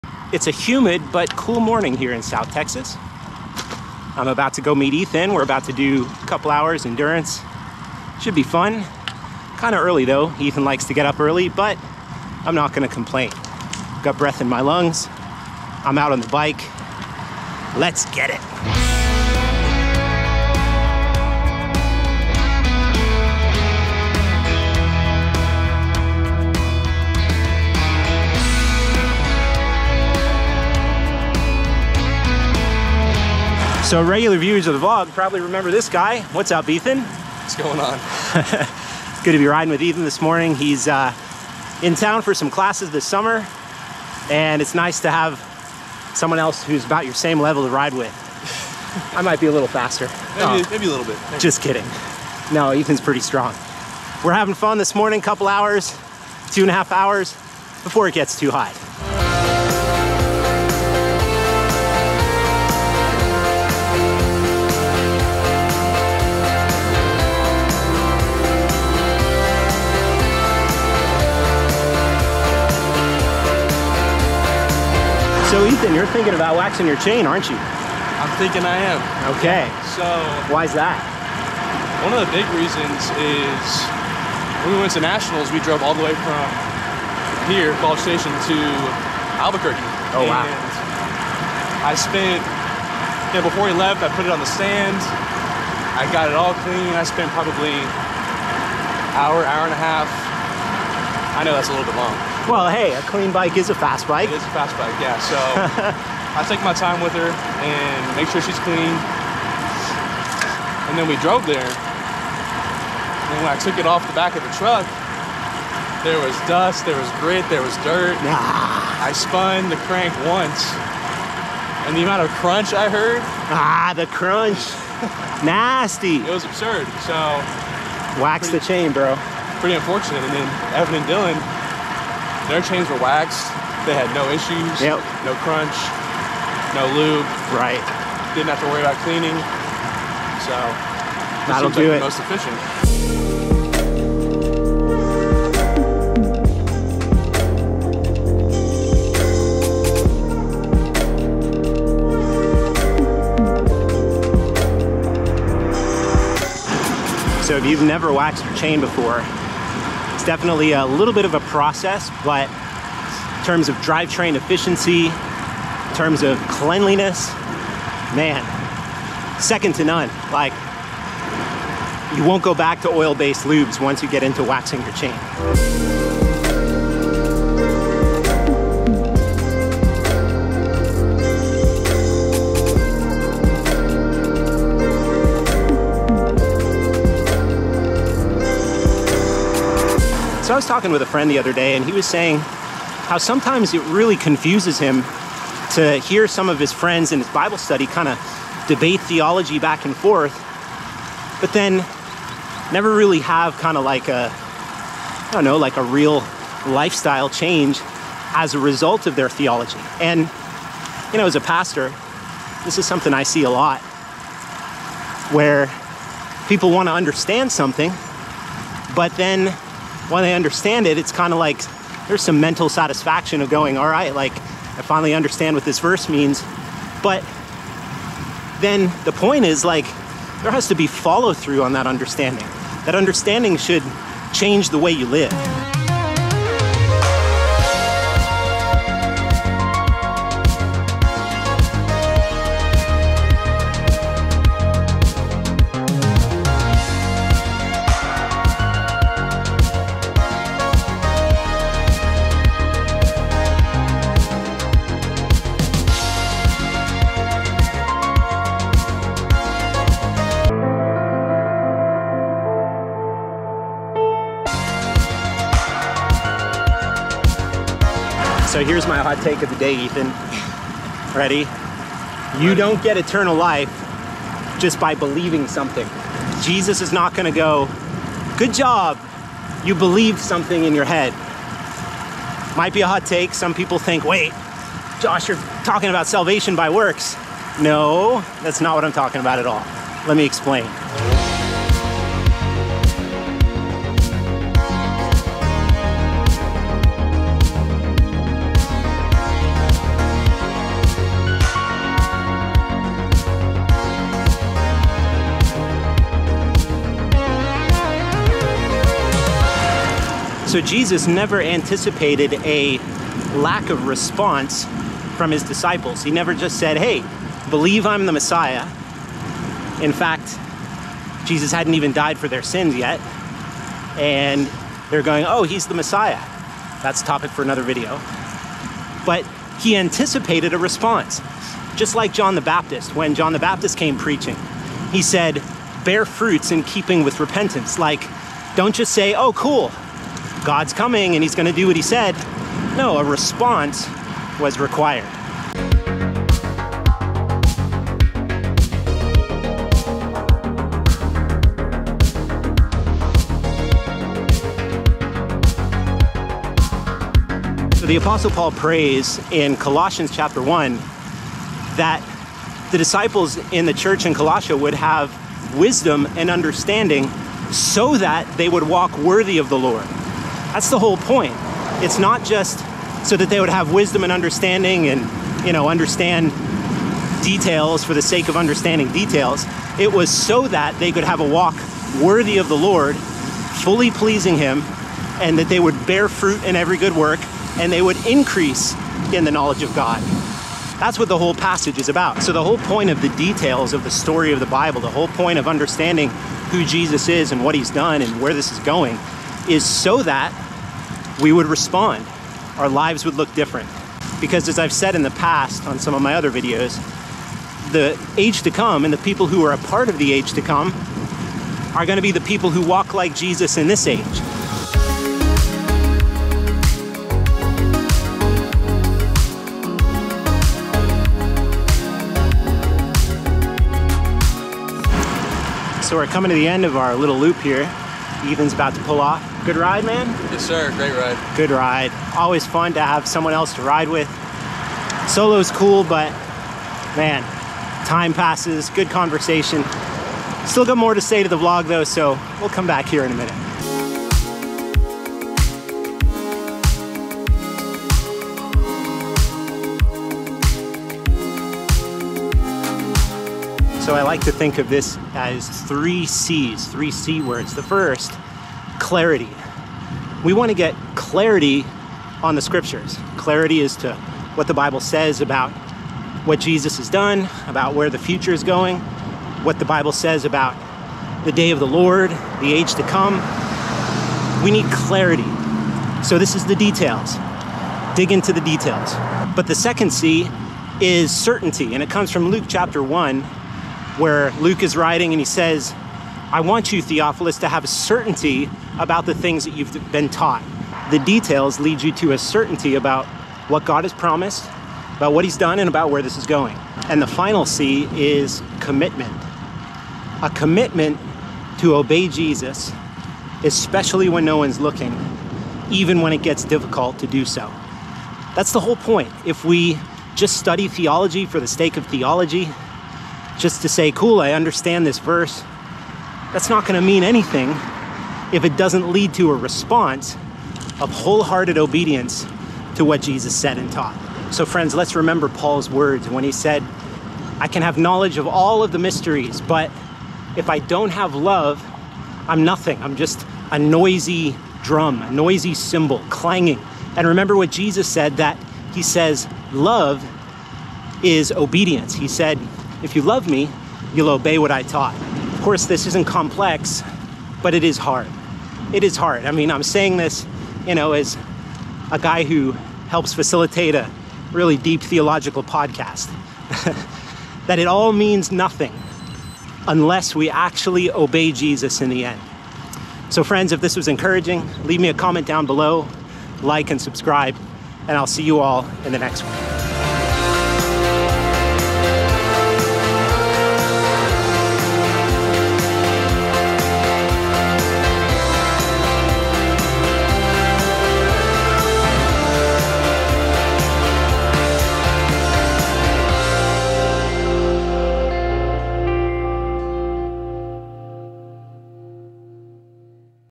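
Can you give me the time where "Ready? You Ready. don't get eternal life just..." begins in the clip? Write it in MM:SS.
04:31.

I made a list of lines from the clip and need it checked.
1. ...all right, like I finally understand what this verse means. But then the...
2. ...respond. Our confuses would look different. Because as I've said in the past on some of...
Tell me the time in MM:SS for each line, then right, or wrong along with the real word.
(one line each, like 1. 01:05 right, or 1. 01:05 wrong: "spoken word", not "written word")
1. 03:43 right
2. 06:41 wrong: "lives", not "confuses".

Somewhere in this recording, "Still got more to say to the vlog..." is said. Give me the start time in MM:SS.
07:20.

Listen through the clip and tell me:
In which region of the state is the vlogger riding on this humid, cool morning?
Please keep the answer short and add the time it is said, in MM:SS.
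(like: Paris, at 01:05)
South Texas, at 00:02.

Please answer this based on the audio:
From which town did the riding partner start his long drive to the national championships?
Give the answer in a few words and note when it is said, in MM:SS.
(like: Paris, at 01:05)
College Station, at 01:27.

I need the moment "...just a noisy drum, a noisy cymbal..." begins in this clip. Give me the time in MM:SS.
08:52.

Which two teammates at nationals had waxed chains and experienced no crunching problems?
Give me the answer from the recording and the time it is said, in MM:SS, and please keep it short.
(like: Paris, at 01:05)
Evan and Dylan, at 02:10.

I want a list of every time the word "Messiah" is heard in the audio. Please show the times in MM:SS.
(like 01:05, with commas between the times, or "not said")
05:18, 05:25.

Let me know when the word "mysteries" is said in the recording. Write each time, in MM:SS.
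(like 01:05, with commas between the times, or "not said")
08:48.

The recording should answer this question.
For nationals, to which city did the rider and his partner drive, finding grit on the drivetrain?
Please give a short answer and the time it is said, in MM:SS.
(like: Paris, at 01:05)
Albuquerque, at 01:29.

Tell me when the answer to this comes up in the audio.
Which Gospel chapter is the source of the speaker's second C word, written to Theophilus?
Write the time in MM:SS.
08:02.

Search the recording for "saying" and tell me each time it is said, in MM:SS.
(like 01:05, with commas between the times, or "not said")
03:12, 09:09.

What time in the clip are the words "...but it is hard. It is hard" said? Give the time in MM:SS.
09:07.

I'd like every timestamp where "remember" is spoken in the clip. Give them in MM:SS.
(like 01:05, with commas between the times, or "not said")
00:35, 08:44, 08:57.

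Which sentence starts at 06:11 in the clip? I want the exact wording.
It's not just so that they would have wisdom and understanding and, you know, understand details for the sake of understanding details.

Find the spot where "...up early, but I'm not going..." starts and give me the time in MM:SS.
00:11.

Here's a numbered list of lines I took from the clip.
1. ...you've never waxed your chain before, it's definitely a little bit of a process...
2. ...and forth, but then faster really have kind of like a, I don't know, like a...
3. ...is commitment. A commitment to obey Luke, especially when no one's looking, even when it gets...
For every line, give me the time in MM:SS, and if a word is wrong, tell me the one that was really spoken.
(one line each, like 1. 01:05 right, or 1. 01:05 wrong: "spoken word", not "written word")
1. 02:37 right
2. 03:19 wrong: "never", not "faster"
3. 08:17 wrong: "Jesus", not "Luke".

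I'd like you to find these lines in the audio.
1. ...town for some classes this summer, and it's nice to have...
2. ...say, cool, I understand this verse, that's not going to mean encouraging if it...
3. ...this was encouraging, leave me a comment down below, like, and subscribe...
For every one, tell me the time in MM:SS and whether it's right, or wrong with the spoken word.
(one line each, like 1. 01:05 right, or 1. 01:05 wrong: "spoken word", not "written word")
1. 00:41 right
2. 08:33 wrong: "anything", not "encouraging"
3. 09:23 right.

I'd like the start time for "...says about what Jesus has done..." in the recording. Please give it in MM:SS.
07:44.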